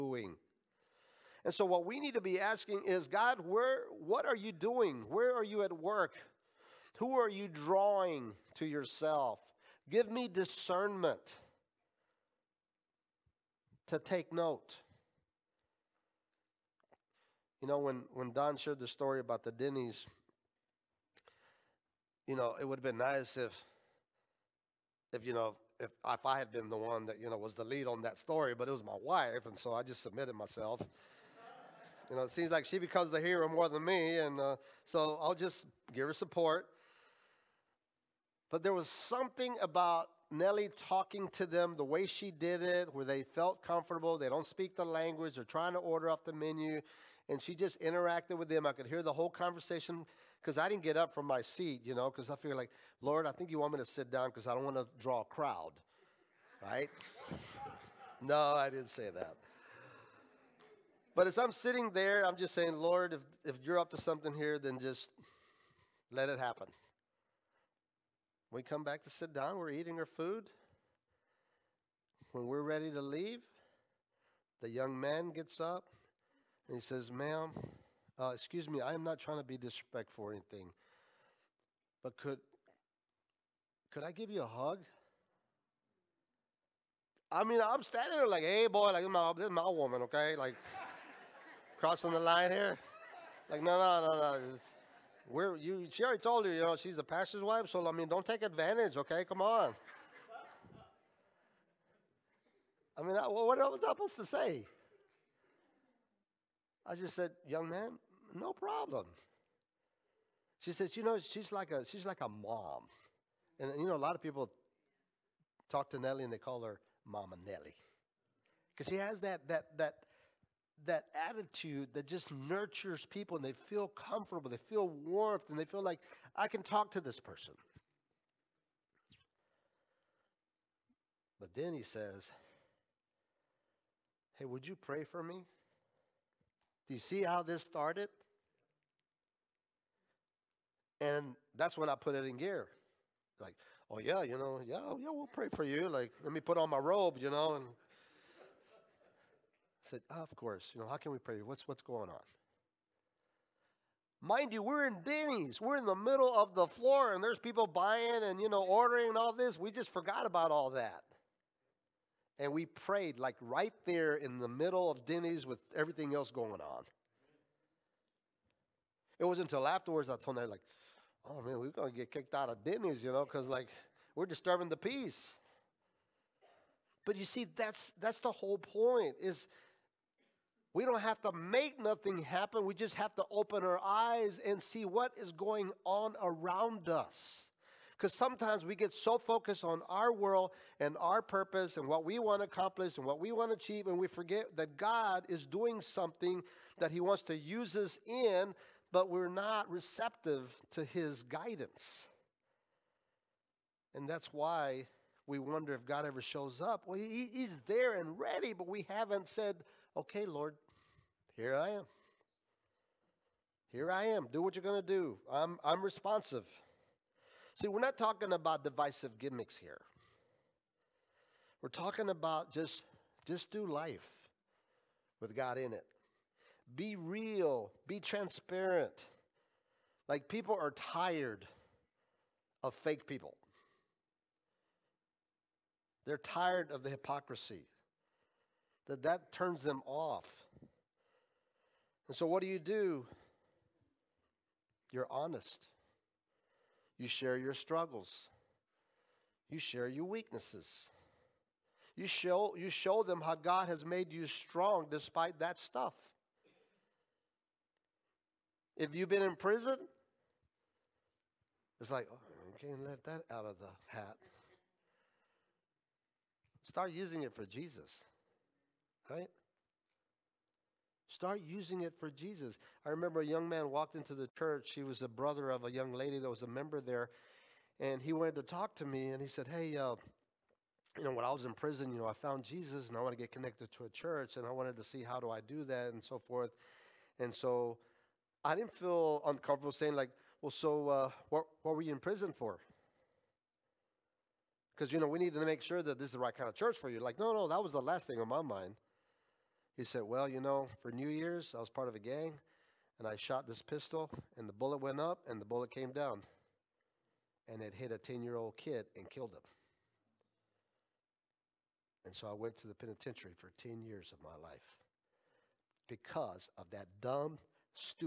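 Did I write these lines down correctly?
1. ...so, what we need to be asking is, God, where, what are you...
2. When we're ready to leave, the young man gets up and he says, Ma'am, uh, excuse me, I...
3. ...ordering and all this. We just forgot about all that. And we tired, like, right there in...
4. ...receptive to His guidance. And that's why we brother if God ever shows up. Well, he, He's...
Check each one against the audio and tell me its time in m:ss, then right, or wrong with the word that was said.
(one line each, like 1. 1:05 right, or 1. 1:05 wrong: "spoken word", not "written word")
1. 0:01 right
2. 1:12 right
3. 2:38 wrong: "prayed", not "tired"
4. 3:19 wrong: "wonder", not "brother".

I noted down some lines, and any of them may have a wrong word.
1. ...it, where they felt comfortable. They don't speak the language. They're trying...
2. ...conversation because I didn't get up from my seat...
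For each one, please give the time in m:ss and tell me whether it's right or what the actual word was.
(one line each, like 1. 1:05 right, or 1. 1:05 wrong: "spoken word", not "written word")
1. 0:42 right
2. 0:49 right.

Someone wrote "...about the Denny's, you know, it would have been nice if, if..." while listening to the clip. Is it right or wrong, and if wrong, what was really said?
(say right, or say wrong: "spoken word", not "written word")
right.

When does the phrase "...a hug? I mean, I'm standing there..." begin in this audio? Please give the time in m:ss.
1:24.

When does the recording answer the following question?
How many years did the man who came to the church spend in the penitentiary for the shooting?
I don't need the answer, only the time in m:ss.
5:13.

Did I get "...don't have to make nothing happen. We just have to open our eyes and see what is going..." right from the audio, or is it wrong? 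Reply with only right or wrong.
right.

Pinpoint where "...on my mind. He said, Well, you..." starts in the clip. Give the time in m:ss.
4:58.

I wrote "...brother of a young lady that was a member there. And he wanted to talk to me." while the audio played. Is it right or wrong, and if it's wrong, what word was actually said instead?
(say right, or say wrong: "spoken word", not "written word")
right.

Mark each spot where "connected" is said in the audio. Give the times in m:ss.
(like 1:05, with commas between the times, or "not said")
4:43.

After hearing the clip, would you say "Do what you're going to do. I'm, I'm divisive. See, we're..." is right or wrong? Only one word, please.
wrong.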